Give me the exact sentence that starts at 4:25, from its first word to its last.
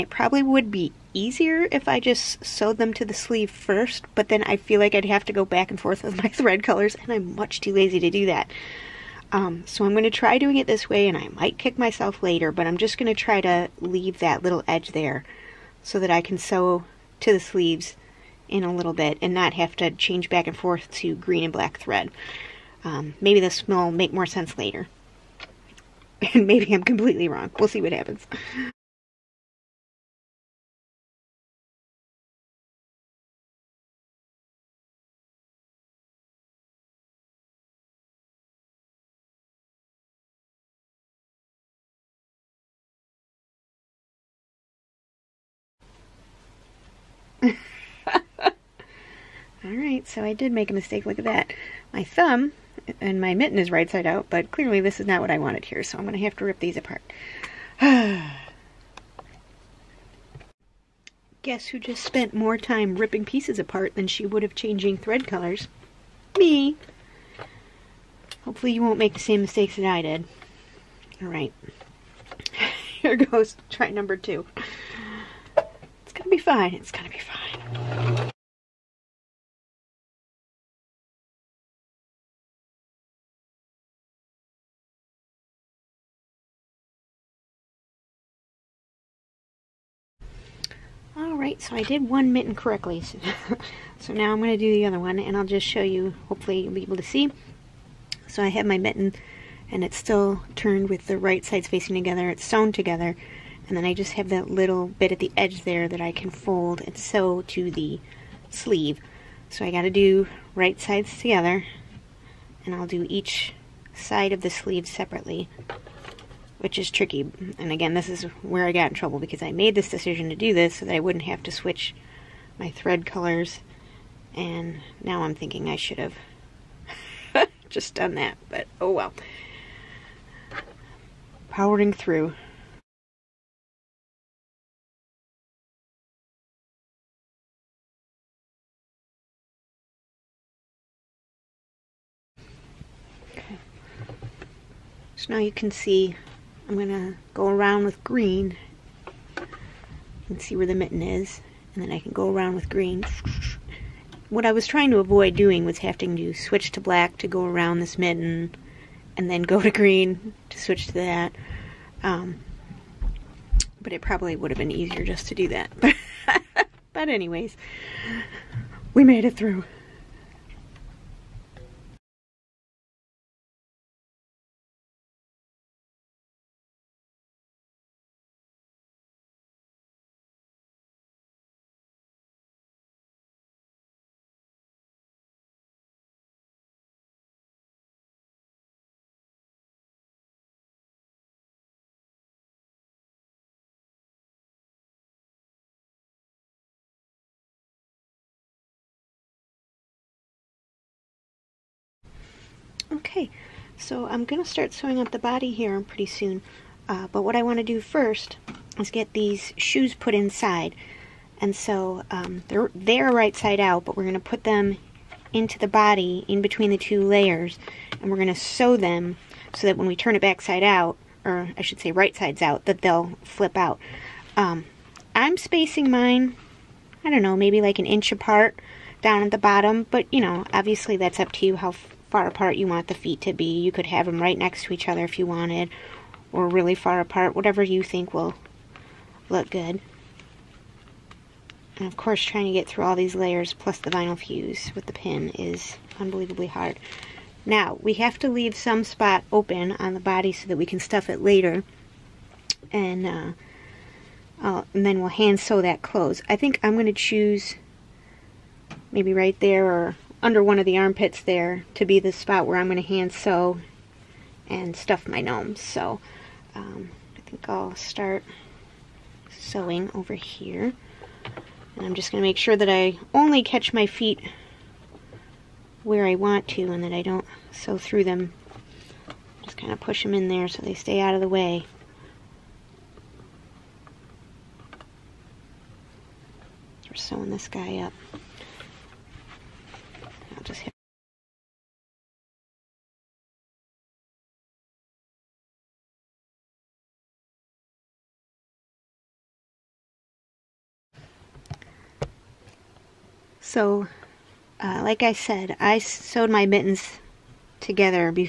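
So um, I think I'll start sewing over here.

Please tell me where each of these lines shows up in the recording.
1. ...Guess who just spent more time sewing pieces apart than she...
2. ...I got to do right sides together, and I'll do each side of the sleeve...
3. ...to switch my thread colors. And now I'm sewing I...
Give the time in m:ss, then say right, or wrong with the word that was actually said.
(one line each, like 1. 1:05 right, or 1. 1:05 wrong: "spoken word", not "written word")
1. 1:01 wrong: "ripping", not "sewing"
2. 1:49 right
3. 2:01 wrong: "thinking", not "sewing".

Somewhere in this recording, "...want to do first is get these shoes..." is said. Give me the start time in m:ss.
3:27.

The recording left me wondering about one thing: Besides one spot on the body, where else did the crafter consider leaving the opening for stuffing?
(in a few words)
under one of the armpits.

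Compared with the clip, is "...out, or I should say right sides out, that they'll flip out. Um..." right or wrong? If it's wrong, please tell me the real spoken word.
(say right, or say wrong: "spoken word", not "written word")
right.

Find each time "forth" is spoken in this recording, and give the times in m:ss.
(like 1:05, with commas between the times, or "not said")
0:05, 0:20.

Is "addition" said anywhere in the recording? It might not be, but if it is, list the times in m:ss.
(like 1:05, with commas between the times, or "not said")
not said.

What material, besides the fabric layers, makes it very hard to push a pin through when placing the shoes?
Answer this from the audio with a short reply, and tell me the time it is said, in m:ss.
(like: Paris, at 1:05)
vinyl fuse, at 4:03.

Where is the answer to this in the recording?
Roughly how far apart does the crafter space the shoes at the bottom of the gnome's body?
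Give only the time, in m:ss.
3:47.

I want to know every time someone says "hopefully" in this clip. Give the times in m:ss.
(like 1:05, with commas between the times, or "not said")
1:08, 1:36.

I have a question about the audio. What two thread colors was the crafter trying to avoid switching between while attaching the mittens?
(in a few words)
green and black.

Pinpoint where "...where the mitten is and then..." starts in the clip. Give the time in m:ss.
2:30.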